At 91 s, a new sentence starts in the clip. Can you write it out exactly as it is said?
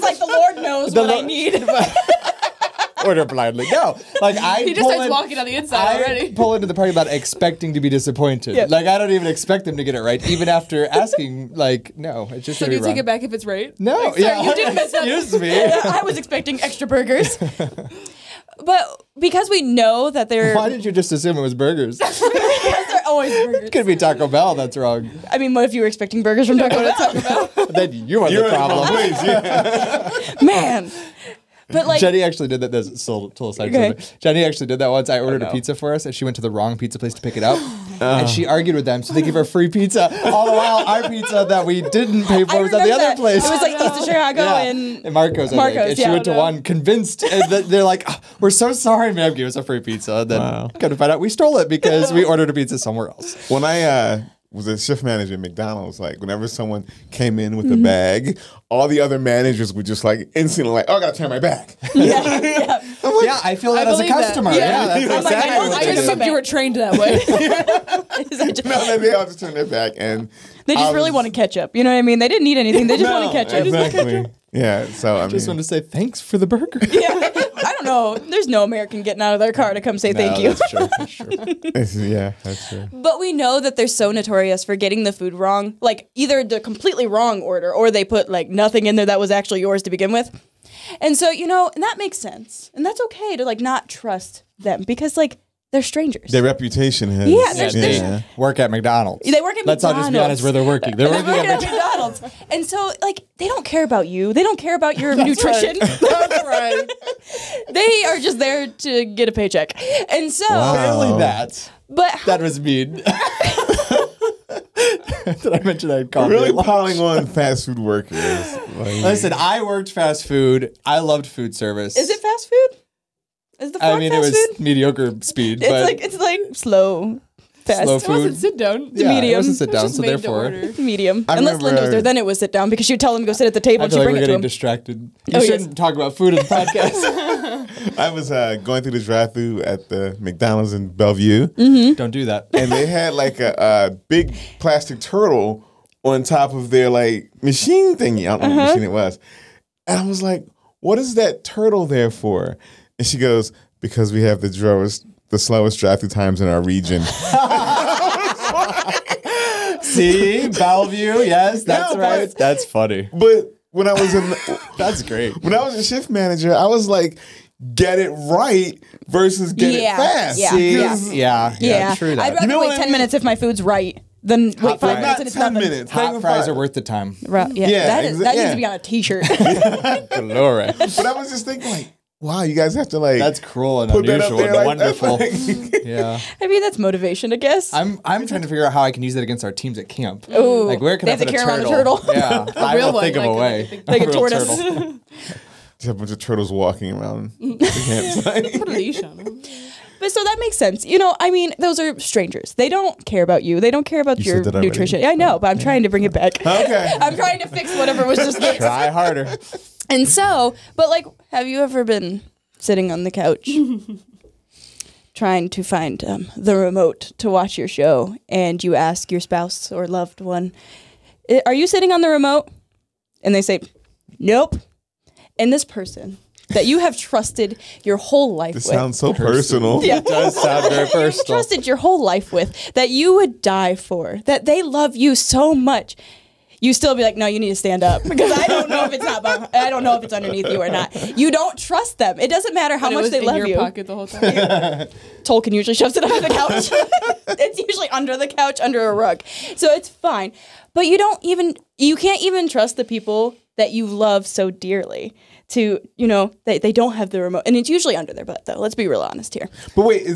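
And so, you know, and that makes sense.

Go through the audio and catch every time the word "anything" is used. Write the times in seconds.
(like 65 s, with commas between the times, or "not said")
72 s.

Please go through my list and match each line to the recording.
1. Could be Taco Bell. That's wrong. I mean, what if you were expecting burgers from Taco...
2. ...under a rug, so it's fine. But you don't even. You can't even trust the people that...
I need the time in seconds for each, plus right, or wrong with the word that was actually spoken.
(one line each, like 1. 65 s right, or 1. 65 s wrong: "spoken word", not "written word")
1. 23 s right
2. 248 s right.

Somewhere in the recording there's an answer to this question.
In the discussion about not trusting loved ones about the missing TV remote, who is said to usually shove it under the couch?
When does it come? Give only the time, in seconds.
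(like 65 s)
245 s.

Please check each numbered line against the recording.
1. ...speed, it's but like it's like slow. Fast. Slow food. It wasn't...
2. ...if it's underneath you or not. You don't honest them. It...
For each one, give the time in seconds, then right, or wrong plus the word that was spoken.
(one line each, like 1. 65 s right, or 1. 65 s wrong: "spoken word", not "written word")
1. 125 s right
2. 239 s wrong: "trust", not "honest".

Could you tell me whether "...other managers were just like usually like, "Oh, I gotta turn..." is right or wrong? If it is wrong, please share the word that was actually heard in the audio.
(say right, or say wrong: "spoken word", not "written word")
wrong: "instantly", not "usually".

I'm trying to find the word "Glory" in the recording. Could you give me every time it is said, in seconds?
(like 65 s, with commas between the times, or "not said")
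179 s.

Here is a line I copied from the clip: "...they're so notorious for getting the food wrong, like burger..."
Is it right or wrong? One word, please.
wrong.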